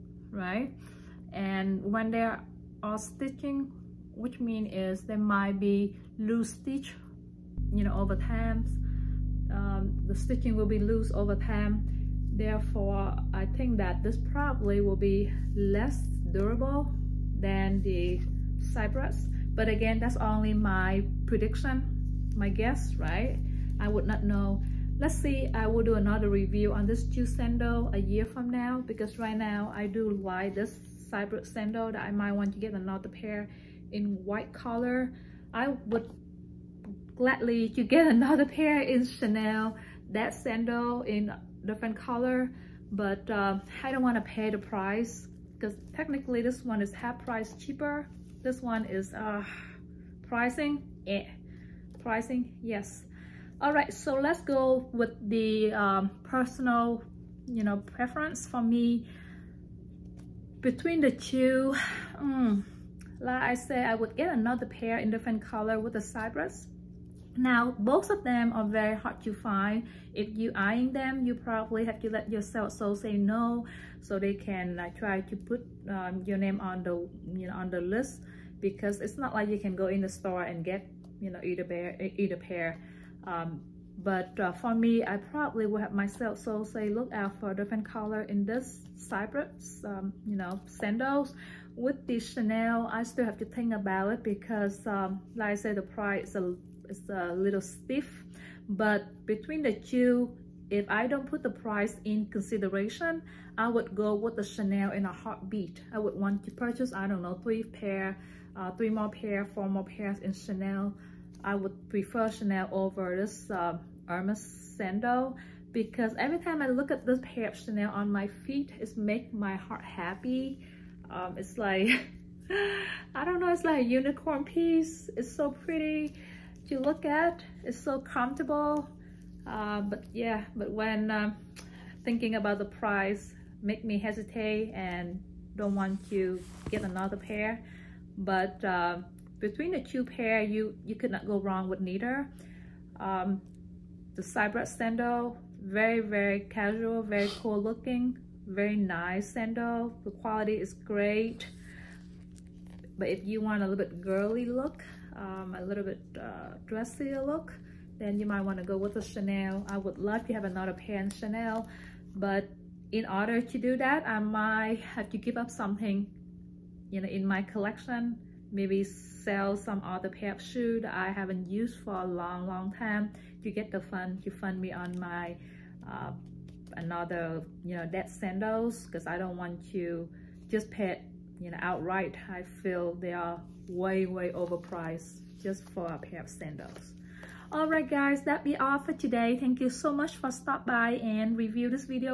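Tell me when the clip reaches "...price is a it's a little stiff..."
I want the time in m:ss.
1:35.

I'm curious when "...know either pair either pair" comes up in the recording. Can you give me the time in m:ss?
1:21.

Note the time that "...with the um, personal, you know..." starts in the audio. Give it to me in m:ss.
0:54.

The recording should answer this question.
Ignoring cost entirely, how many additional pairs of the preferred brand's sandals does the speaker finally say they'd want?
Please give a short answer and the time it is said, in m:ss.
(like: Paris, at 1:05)
4, at 1:49.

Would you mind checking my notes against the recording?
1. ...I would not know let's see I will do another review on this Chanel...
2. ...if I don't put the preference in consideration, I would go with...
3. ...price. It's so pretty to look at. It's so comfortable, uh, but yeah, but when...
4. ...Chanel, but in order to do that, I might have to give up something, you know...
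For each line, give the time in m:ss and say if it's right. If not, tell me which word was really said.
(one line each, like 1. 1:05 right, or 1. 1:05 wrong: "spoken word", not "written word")
1. 0:23 wrong: "Jew", not "Chanel"
2. 1:40 wrong: "price", not "preference"
3. 2:04 wrong: "piece", not "price"
4. 2:41 right.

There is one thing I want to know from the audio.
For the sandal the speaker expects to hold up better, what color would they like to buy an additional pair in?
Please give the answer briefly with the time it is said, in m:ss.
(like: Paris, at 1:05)
white, at 0:34.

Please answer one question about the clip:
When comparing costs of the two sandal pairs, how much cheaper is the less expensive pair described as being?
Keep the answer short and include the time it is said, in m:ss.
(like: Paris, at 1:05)
half price, at 0:46.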